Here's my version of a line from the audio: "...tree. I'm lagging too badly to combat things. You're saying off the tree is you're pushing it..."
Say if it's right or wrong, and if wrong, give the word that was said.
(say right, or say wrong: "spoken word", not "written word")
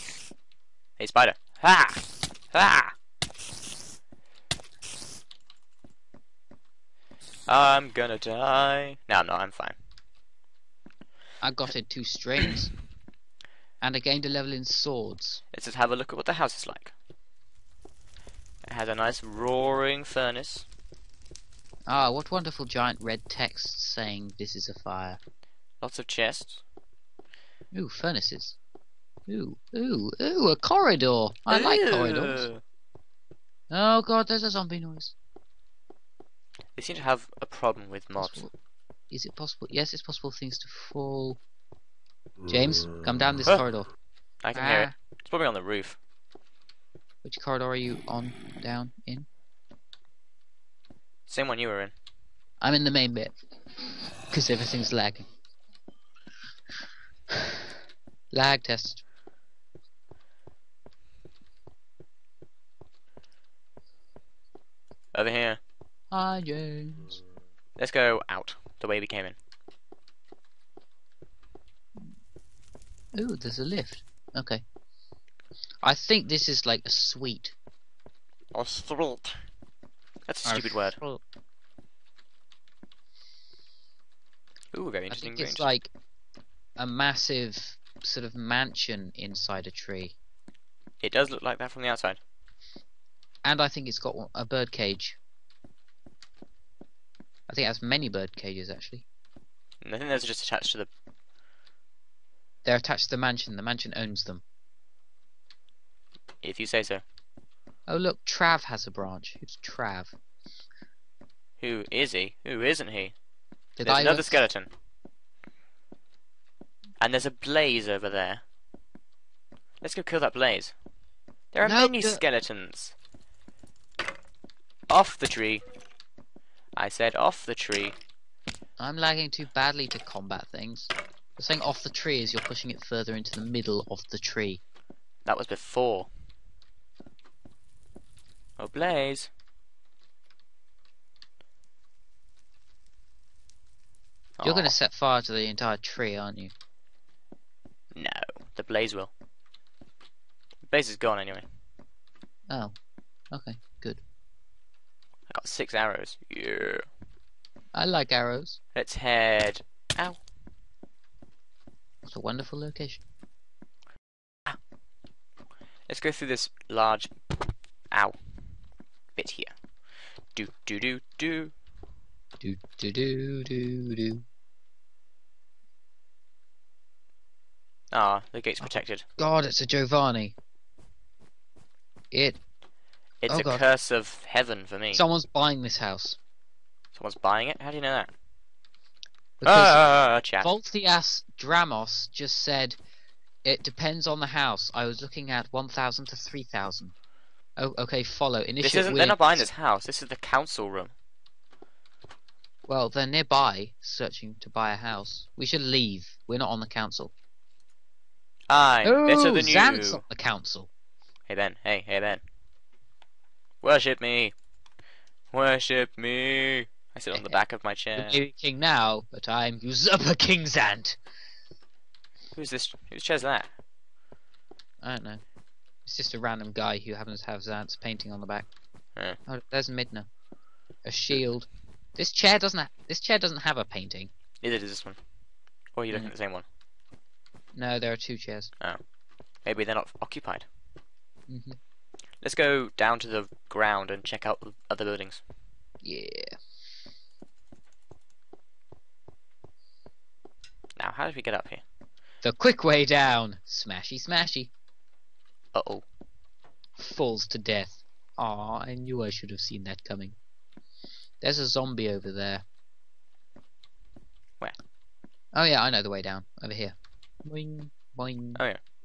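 right.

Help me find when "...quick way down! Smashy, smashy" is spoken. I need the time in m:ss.
4:12.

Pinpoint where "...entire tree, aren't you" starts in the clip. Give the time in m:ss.
2:25.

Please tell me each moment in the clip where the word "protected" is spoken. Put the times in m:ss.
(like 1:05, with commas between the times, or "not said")
2:58.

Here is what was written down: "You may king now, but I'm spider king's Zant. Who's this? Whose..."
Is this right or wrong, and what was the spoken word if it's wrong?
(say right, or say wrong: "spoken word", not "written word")
wrong: "usurper", not "spider".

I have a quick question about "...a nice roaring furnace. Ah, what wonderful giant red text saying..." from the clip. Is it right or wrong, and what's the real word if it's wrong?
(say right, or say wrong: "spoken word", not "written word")
right.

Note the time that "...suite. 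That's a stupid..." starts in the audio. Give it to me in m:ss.
1:18.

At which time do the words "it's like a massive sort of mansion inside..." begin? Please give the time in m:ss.
1:25.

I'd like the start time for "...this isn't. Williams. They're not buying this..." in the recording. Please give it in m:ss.
3:18.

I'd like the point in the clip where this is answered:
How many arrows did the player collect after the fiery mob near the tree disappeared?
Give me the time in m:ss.
2:35.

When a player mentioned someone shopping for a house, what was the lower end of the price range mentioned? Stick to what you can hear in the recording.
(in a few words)
1000.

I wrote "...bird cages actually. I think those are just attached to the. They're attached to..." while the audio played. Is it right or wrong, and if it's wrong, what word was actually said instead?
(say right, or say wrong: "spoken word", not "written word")
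right.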